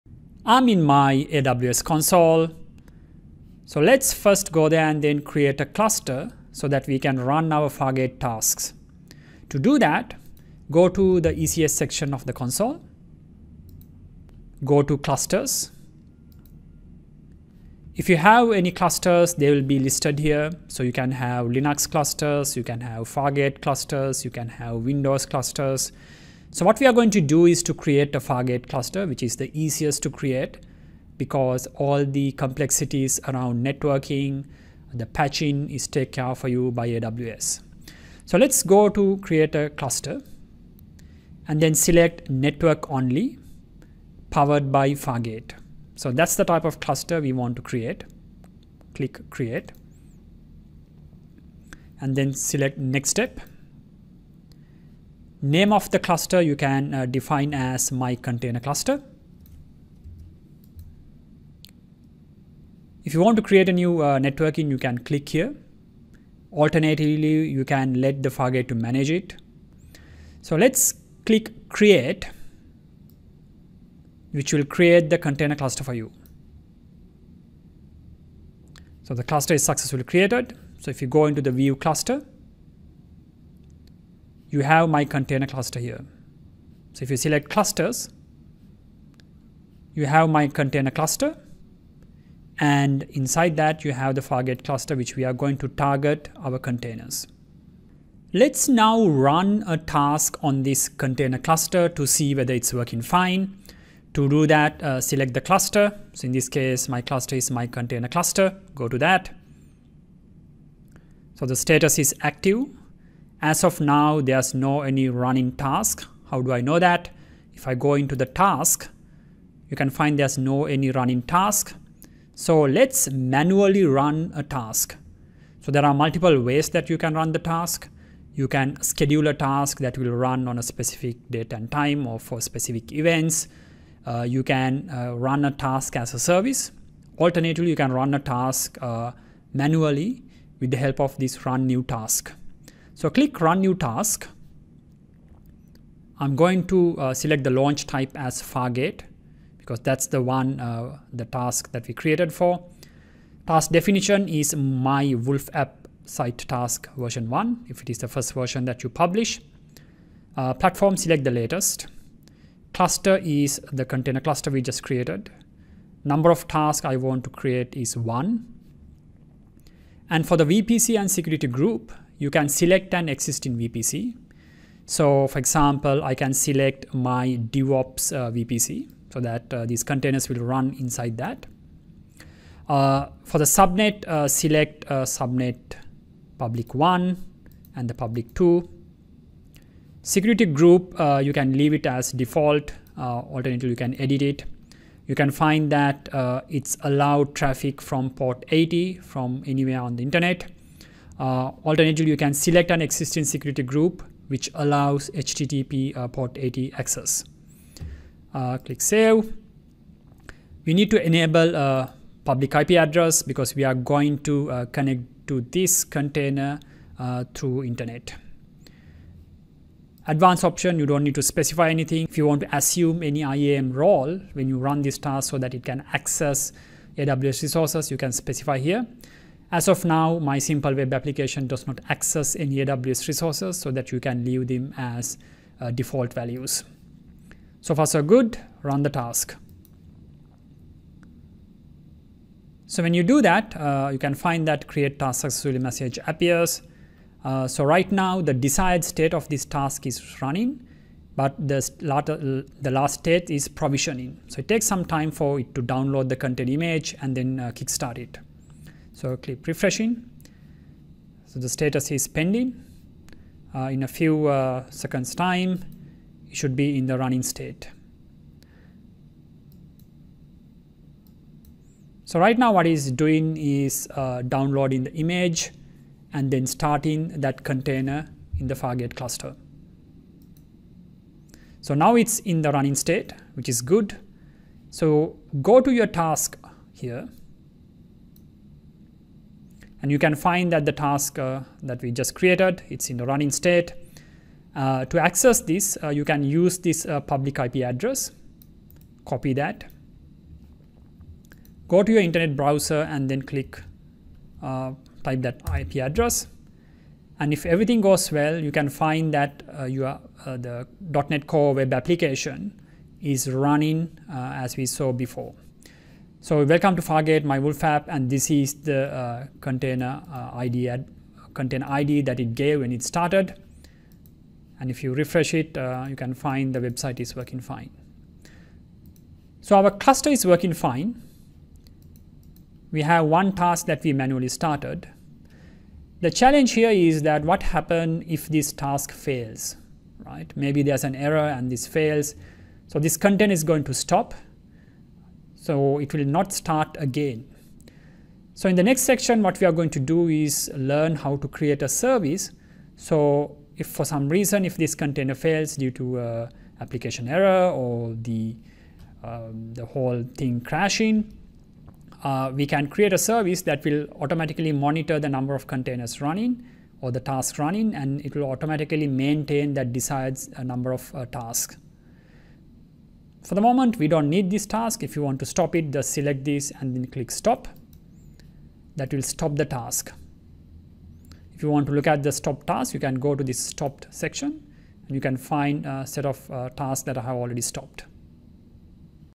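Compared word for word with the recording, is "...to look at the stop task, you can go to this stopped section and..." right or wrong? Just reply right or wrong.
right.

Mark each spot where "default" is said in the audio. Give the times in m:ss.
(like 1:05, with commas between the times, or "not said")
3:12, 3:55.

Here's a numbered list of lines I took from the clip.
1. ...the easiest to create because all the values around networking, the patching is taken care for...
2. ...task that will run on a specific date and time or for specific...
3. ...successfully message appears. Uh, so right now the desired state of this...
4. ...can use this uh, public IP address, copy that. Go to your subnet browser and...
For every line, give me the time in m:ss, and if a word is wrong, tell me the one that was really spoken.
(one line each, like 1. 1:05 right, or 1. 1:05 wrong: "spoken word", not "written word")
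1. 0:29 wrong: "complexities", not "values"
2. 2:09 right
3. 4:05 right
4. 4:56 wrong: "internet", not "subnet".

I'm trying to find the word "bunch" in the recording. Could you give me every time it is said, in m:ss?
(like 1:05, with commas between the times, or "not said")
not said.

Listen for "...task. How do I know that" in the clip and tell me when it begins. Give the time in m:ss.
1:55.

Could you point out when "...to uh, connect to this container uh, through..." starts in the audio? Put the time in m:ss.
3:34.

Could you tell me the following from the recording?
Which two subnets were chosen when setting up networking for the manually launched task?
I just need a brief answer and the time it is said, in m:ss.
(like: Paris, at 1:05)
public 1 and public 2, at 3:05.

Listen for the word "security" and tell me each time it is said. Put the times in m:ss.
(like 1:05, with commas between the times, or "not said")
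2:51, 3:10, 3:23.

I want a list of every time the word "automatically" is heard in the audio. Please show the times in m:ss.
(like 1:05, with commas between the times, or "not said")
6:03, 6:08.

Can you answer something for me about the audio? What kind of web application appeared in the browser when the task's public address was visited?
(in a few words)
.NET Core web application.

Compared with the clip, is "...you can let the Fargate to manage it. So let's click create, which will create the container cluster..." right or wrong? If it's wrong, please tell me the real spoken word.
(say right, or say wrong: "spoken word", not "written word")
right.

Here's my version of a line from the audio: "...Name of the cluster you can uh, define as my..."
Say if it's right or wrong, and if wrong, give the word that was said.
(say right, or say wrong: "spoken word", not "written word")
right.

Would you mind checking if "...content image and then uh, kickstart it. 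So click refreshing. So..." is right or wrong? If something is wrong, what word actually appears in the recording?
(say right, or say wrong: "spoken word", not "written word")
right.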